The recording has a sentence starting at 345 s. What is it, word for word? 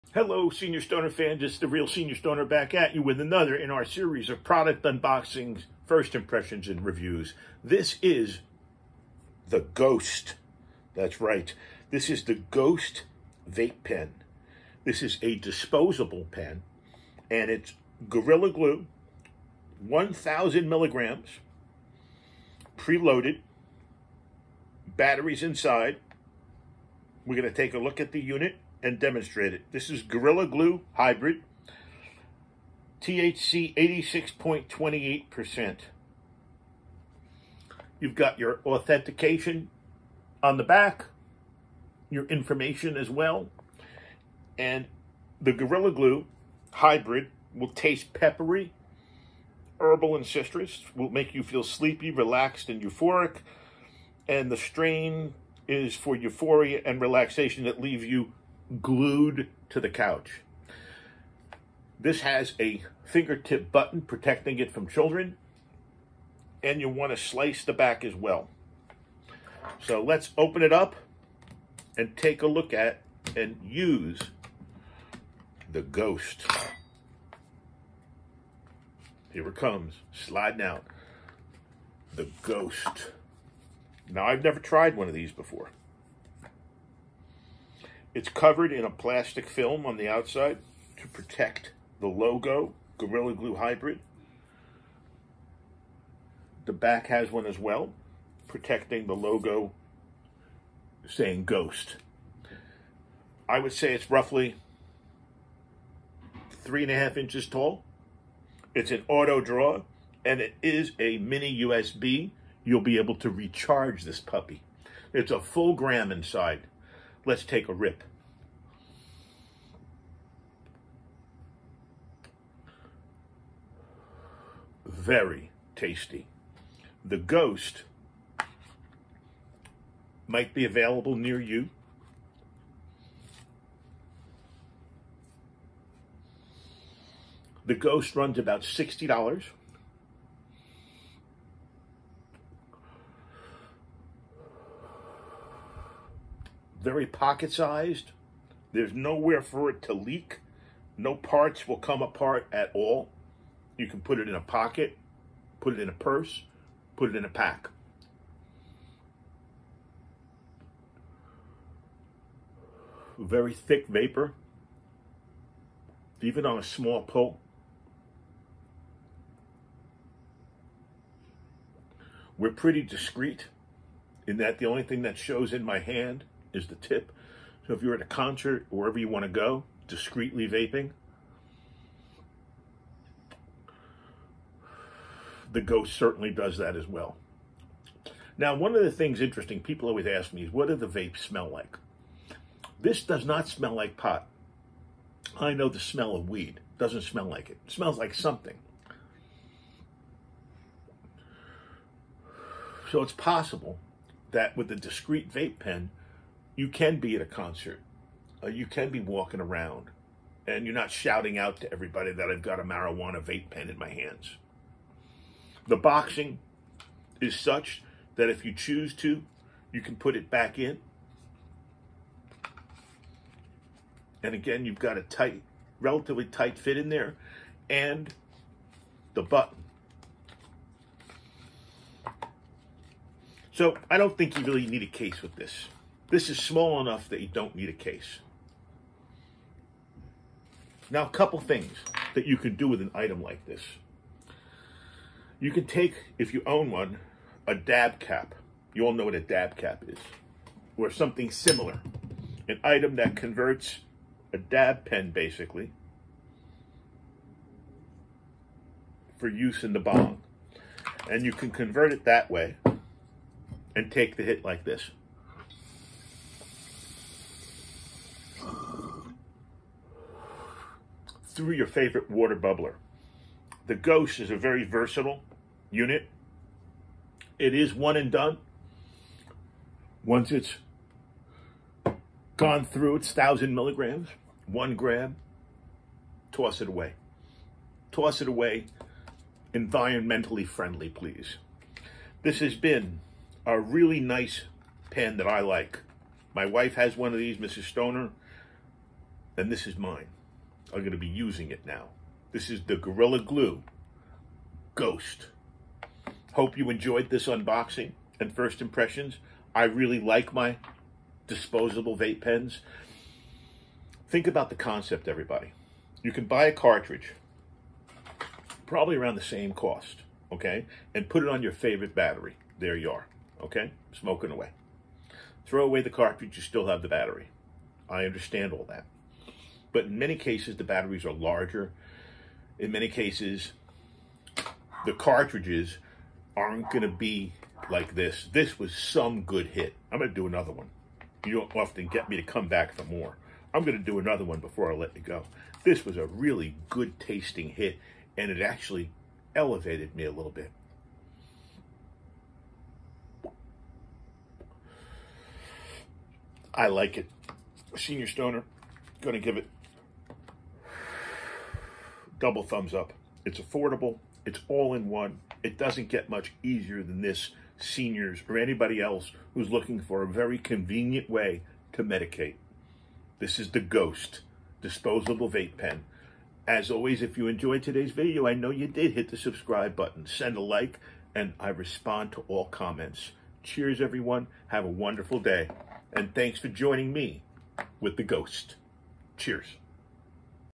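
This was a really good tasting hit, and it actually elevated me a little bit.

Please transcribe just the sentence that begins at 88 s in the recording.
It's covered in a plastic film on the outside to protect the logo, Gorilla Glue Hybrid.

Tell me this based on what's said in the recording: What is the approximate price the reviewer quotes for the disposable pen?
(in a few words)
$60.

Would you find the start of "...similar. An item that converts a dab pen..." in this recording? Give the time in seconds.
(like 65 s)
251 s.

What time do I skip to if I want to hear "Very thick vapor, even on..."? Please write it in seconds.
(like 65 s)
163 s.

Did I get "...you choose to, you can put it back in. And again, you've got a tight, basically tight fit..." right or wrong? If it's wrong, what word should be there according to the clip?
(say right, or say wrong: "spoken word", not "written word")
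wrong: "relatively", not "basically".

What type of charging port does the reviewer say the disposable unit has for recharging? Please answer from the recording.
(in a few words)
mini USB.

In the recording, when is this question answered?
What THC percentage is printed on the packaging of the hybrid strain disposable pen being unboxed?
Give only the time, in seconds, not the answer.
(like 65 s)
33 s.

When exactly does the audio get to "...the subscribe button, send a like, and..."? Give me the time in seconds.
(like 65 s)
379 s.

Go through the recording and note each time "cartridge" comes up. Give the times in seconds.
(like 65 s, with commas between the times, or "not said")
316 s, 325 s, 334 s.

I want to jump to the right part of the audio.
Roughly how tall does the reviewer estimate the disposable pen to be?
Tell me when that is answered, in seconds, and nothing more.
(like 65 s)
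106 s.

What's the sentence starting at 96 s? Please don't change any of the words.
The back has one as well, protecting the logo saying ghost.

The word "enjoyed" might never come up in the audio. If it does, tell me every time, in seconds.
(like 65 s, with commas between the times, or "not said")
306 s, 377 s.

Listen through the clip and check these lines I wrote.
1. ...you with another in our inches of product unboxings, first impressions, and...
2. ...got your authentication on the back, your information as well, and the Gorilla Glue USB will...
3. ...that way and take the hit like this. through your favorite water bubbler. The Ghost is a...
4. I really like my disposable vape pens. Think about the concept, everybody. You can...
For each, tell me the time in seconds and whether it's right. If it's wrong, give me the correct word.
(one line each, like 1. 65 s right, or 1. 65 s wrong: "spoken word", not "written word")
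1. 2 s wrong: "series", not "inches"
2. 38 s wrong: "Hybrid", not "USB"
3. 262 s right
4. 309 s right.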